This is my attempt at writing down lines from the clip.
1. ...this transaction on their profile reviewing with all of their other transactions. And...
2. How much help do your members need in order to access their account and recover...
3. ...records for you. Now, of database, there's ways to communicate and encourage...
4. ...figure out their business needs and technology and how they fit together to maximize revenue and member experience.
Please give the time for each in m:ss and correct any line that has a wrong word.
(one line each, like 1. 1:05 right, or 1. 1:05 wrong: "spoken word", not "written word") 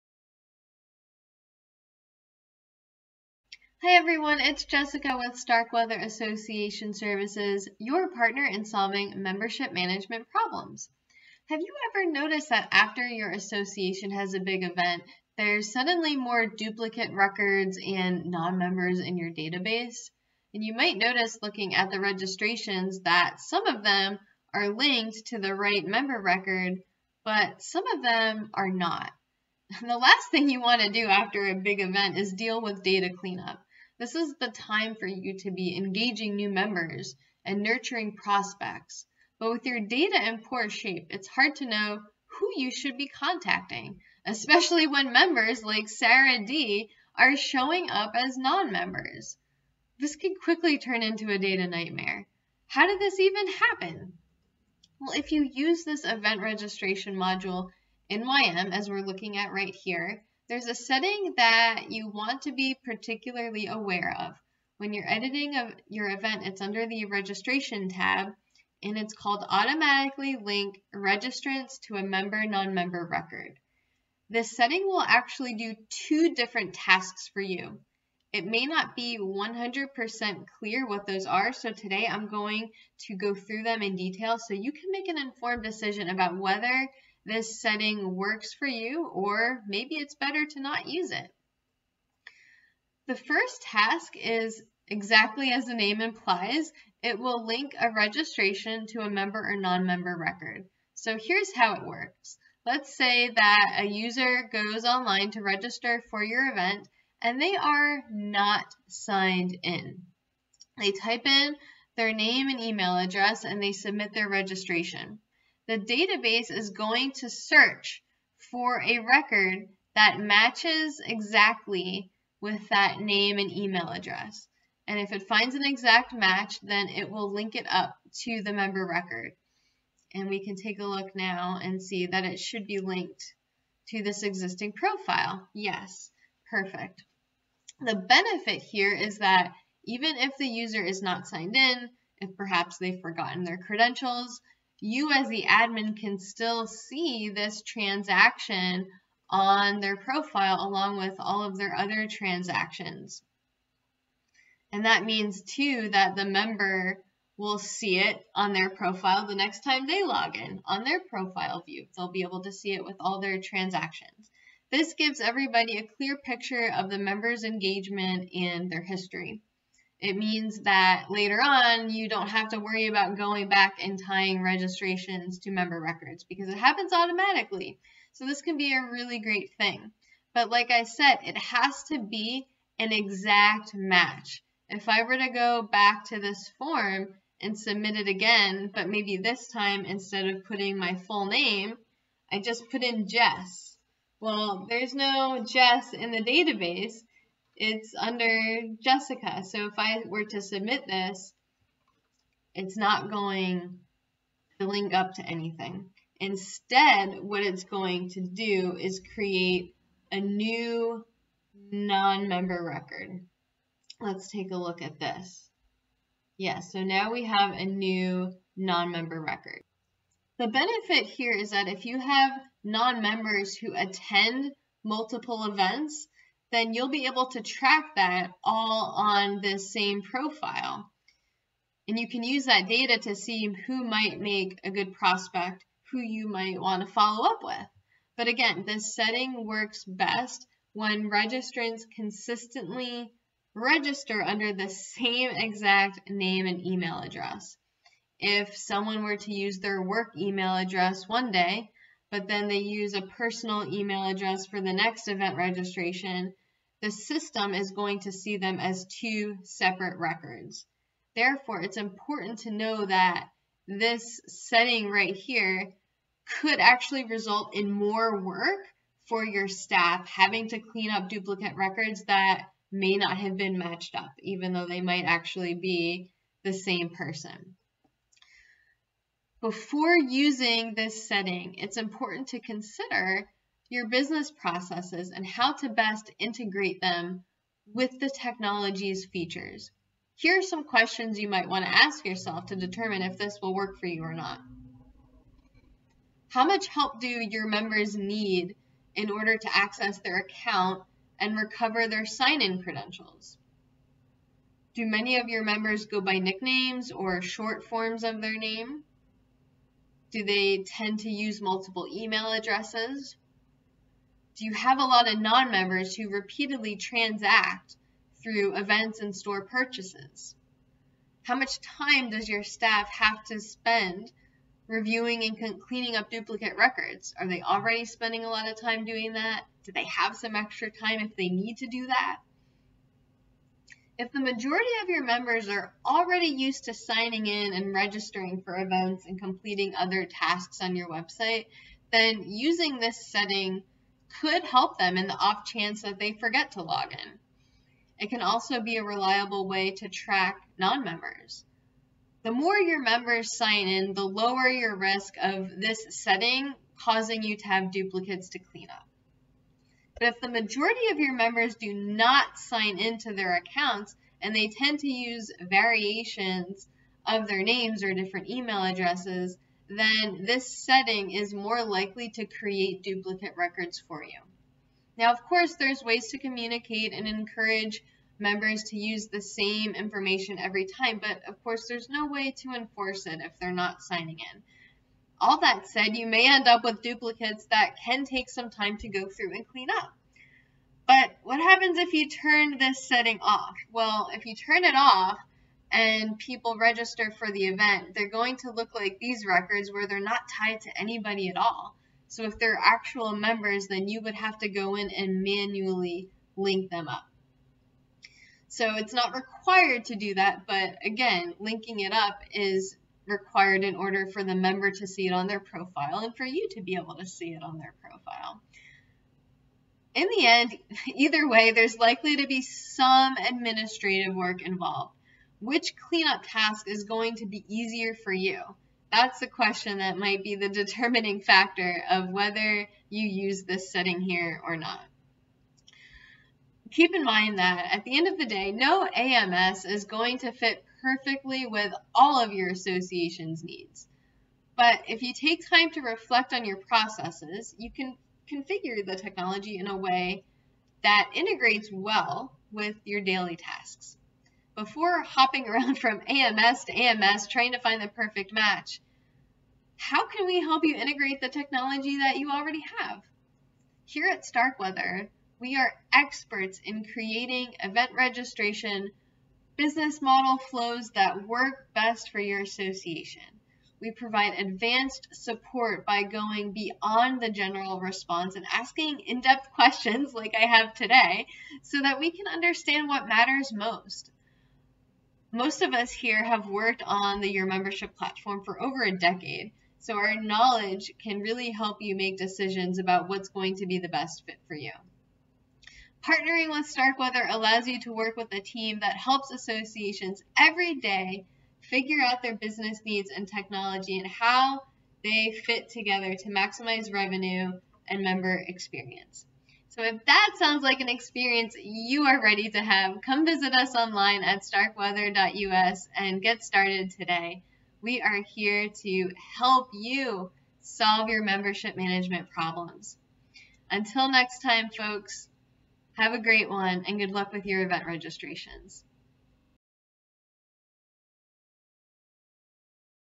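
1. 2:27 wrong: "along", not "reviewing"
2. 4:56 right
3. 6:13 wrong: "course", not "database"
4. 8:21 right.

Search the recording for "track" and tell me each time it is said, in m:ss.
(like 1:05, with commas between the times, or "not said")
3:47, 5:49.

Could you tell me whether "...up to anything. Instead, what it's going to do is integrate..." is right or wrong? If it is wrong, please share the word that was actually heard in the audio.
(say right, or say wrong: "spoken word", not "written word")
wrong: "create", not "integrate".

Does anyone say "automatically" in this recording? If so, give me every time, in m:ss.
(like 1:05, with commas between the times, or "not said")
1:09, 2:56.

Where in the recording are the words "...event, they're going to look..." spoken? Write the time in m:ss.
6:37.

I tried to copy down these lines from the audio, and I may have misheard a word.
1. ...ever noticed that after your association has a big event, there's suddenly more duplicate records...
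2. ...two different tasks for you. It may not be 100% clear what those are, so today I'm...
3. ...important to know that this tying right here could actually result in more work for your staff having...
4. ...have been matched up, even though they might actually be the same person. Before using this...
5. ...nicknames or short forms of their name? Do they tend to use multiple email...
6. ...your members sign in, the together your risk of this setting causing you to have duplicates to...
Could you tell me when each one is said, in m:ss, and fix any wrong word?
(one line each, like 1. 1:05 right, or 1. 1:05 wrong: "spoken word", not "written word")
1. 0:11 right
2. 1:15 right
3. 4:21 wrong: "setting", not "tying"
4. 4:33 right
5. 5:06 right
6. 5:52 wrong: "lower", not "together".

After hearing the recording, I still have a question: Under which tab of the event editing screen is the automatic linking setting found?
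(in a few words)
registration tab.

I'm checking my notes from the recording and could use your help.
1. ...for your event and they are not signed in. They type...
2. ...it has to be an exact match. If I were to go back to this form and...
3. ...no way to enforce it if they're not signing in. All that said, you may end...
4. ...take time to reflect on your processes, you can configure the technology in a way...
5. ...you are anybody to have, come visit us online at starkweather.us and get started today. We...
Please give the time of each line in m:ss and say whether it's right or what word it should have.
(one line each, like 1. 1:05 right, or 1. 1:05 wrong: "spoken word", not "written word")
1. 1:46 right
2. 3:01 right
3. 6:21 right
4. 7:25 right
5. 8:31 wrong: "ready", not "anybody".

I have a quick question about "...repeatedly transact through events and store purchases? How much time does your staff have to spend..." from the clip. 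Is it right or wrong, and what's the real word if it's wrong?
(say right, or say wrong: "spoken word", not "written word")
right.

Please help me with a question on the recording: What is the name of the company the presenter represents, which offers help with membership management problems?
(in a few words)
Starkweather Association Services.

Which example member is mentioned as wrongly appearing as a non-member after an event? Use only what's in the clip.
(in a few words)
Sarah D.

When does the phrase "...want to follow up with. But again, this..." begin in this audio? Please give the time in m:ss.
3:56.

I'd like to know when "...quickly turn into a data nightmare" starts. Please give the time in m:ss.
0:50.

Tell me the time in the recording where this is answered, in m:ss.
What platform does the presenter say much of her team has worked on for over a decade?
8:07.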